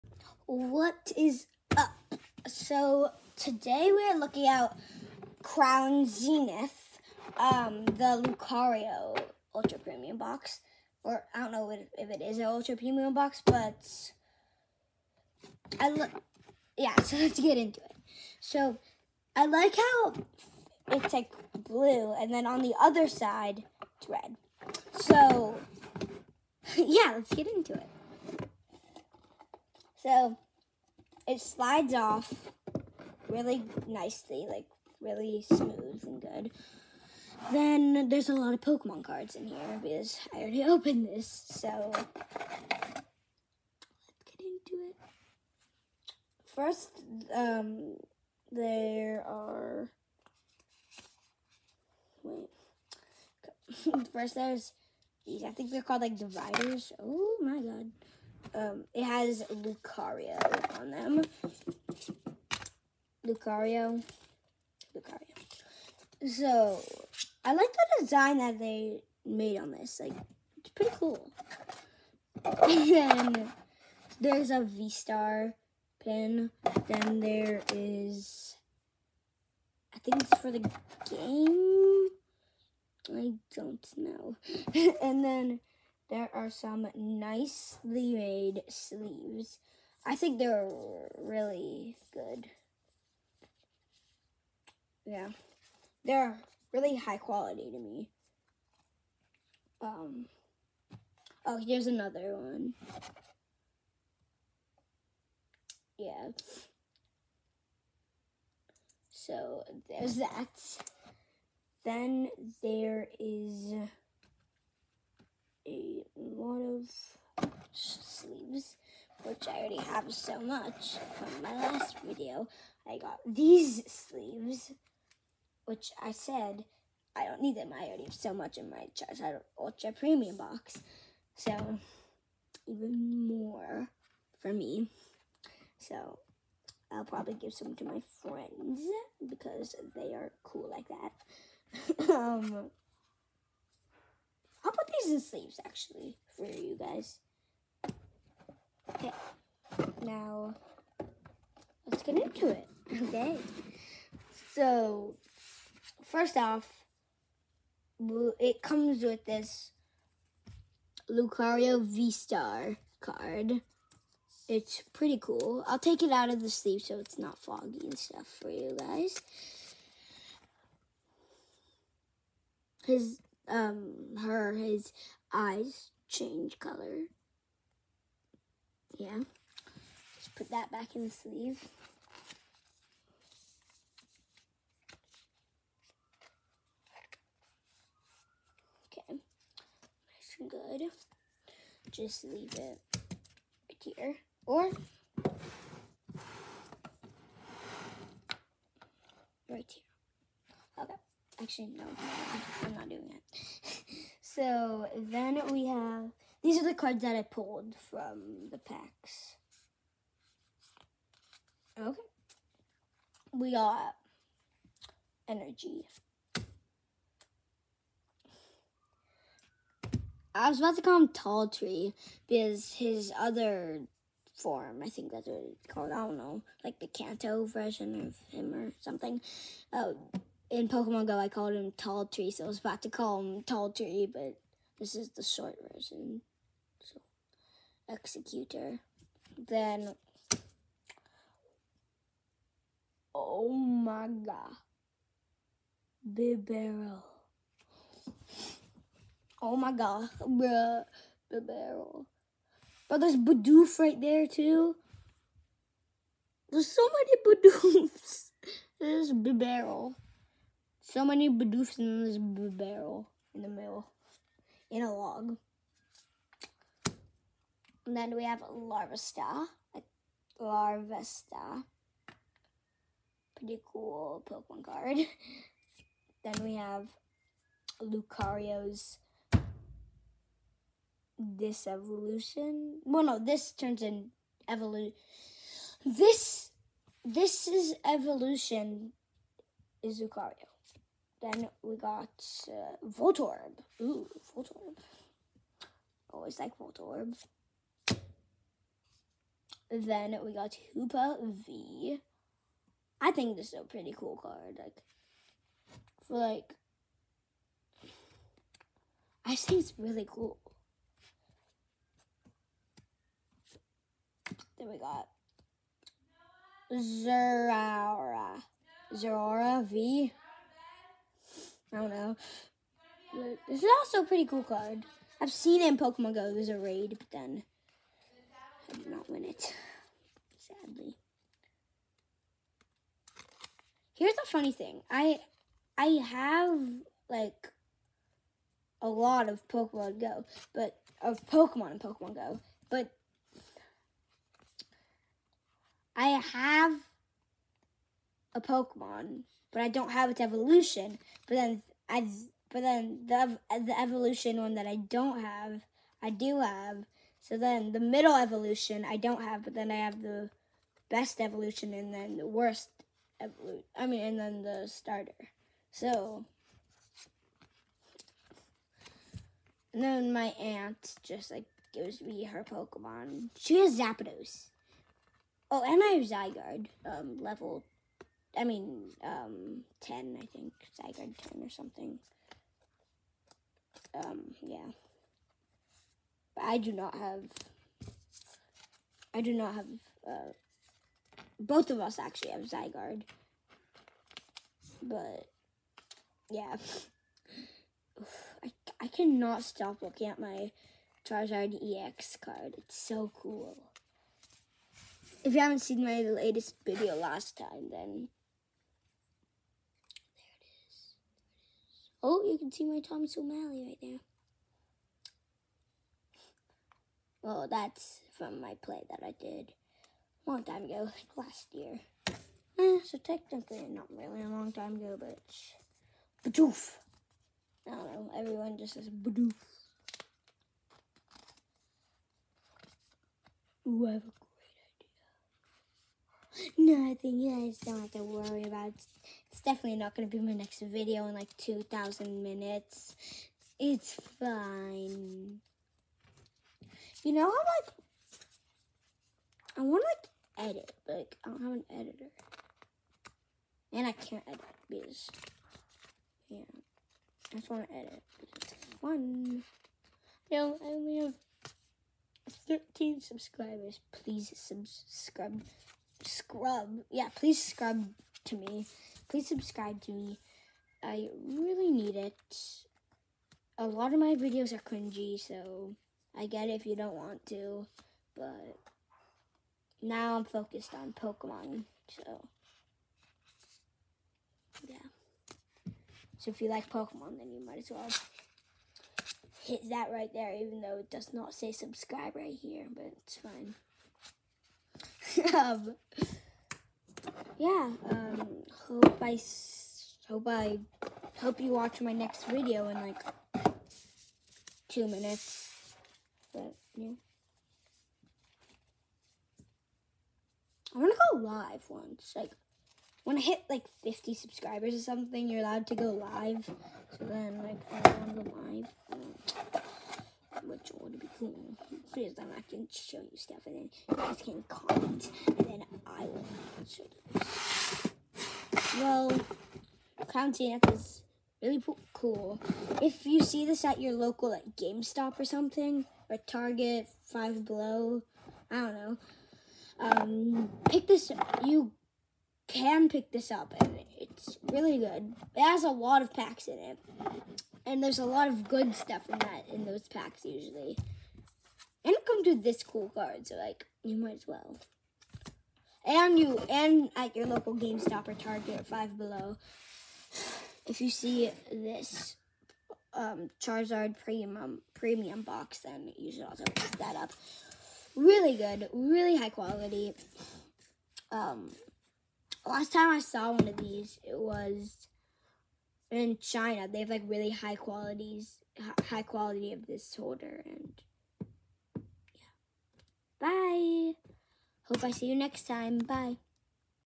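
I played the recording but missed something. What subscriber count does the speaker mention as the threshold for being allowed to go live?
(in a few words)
50.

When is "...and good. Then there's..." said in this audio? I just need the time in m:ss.
0:36.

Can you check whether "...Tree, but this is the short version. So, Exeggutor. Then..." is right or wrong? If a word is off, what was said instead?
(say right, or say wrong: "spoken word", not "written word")
right.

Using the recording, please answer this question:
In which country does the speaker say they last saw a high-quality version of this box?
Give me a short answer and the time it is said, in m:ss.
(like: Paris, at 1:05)
China, at 9:36.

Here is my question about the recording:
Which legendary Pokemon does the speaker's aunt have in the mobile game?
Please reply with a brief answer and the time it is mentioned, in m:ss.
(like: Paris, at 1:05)
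Zapdos, at 6:13.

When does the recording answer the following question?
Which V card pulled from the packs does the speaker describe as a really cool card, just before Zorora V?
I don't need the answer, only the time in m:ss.
5:00.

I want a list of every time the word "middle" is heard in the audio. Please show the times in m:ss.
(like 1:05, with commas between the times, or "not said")
4:23, 5:57.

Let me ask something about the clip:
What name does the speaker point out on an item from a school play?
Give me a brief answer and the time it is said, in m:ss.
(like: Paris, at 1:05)
Thomas O'Malley, at 6:52.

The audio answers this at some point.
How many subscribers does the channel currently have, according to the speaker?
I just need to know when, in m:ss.
7:42.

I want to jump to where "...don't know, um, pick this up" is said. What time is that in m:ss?
8:58.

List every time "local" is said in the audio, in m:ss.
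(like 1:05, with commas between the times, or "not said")
8:53, 9:17.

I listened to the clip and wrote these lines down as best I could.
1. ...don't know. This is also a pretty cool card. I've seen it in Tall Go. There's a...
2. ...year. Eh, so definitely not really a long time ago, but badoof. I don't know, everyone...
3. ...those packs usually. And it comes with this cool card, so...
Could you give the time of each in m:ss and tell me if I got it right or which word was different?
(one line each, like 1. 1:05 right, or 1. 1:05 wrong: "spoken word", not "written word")
1. 5:21 wrong: "Pokemon", not "Tall"
2. 7:01 wrong: "technically", not "definitely"
3. 9:09 right.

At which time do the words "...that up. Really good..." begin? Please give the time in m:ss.
9:26.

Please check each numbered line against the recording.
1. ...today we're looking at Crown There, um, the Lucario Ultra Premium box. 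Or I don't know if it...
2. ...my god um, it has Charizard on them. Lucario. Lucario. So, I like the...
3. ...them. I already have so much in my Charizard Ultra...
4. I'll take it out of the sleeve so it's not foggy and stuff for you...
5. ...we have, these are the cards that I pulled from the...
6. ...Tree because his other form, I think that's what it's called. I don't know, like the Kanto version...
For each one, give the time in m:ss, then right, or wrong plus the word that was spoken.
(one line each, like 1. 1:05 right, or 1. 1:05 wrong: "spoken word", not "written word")
1. 0:03 wrong: "Zenith", not "There"
2. 0:57 wrong: "Lucario", not "Charizard"
3. 2:07 right
4. 2:45 right
5. 3:25 right
6. 3:41 right.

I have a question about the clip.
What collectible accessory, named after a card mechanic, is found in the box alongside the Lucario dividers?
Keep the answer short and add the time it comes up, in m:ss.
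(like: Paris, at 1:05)
V-Star pin, at 1:14.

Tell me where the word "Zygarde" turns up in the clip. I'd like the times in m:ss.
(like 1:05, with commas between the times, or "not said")
6:16, 6:20, 6:32.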